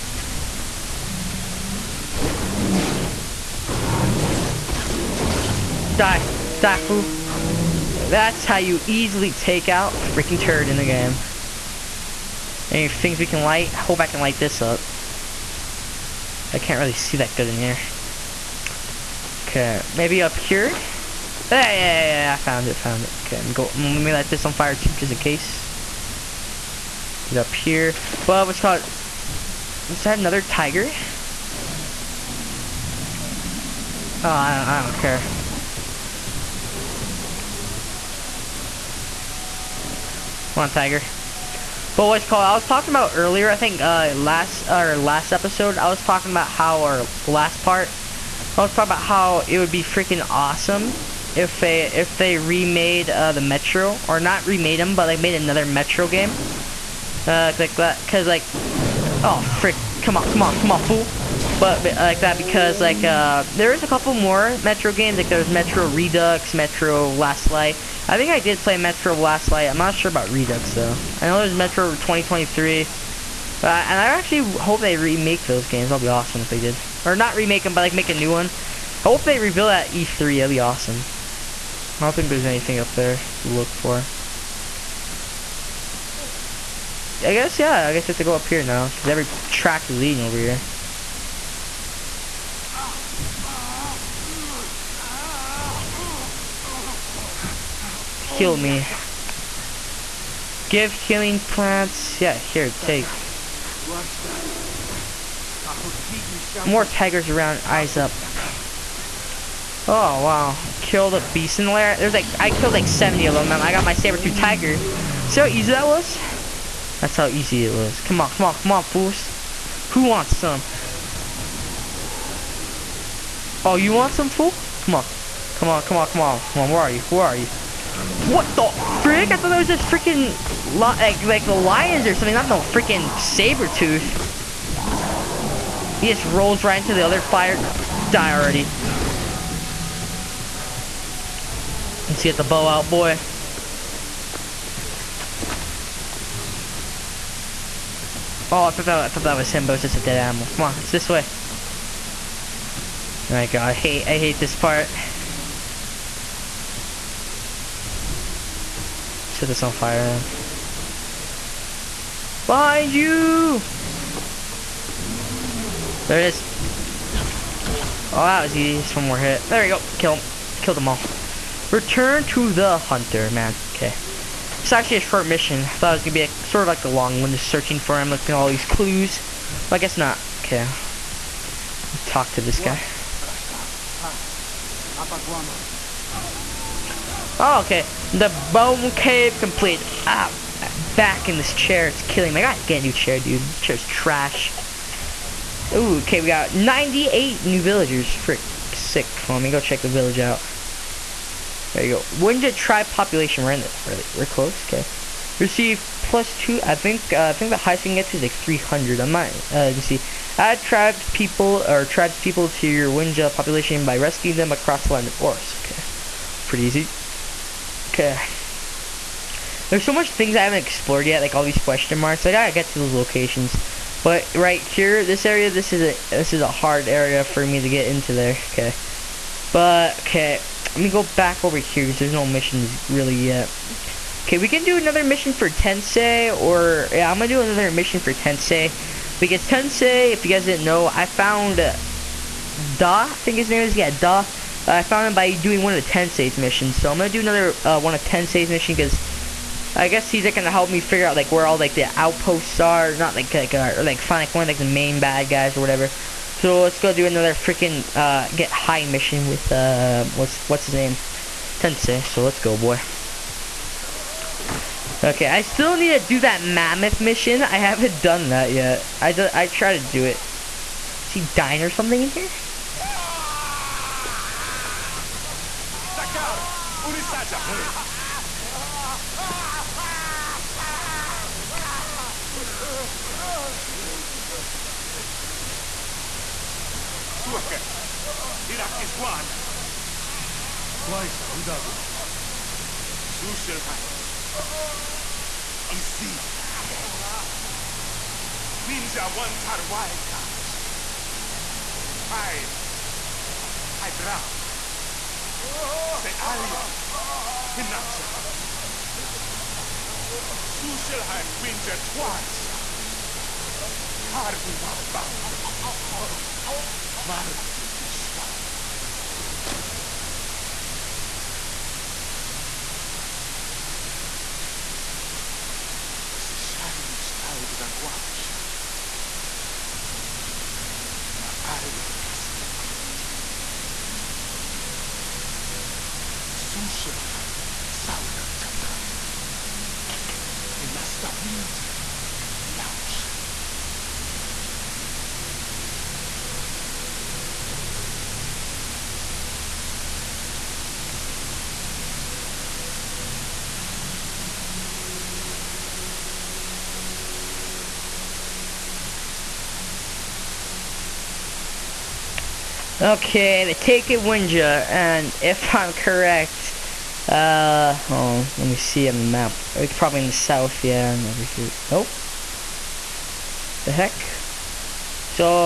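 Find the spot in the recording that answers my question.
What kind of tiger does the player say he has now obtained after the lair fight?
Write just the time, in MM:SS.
01:53.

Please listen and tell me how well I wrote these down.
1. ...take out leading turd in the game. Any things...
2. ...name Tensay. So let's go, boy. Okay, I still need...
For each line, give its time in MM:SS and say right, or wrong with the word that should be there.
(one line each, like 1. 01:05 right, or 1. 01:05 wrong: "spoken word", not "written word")
1. 00:09 wrong: "freaking", not "leading"
2. 04:20 right.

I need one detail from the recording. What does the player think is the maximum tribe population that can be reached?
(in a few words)
300.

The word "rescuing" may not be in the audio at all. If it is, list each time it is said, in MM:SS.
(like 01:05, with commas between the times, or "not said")
03:33.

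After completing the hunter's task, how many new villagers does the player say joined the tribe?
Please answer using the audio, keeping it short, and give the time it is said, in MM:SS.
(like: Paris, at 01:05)
98, at 03:16.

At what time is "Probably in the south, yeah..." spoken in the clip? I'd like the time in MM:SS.
06:09.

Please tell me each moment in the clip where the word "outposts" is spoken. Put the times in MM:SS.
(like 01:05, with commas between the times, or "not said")
04:11.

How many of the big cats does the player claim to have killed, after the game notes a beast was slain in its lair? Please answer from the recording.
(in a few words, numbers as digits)
70.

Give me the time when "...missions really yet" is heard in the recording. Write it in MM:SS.
03:52.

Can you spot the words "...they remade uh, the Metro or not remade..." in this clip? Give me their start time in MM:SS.
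00:52.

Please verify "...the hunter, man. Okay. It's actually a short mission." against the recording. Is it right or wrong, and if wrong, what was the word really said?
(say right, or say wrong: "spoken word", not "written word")
right.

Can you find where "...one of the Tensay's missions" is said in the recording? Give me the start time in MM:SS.
04:05.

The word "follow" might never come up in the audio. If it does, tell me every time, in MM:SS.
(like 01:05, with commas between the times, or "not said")
not said.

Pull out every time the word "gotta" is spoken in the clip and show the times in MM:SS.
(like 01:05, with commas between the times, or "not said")
03:12, 03:42.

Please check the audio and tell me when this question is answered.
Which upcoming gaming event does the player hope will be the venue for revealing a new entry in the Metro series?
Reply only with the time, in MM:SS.
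01:19.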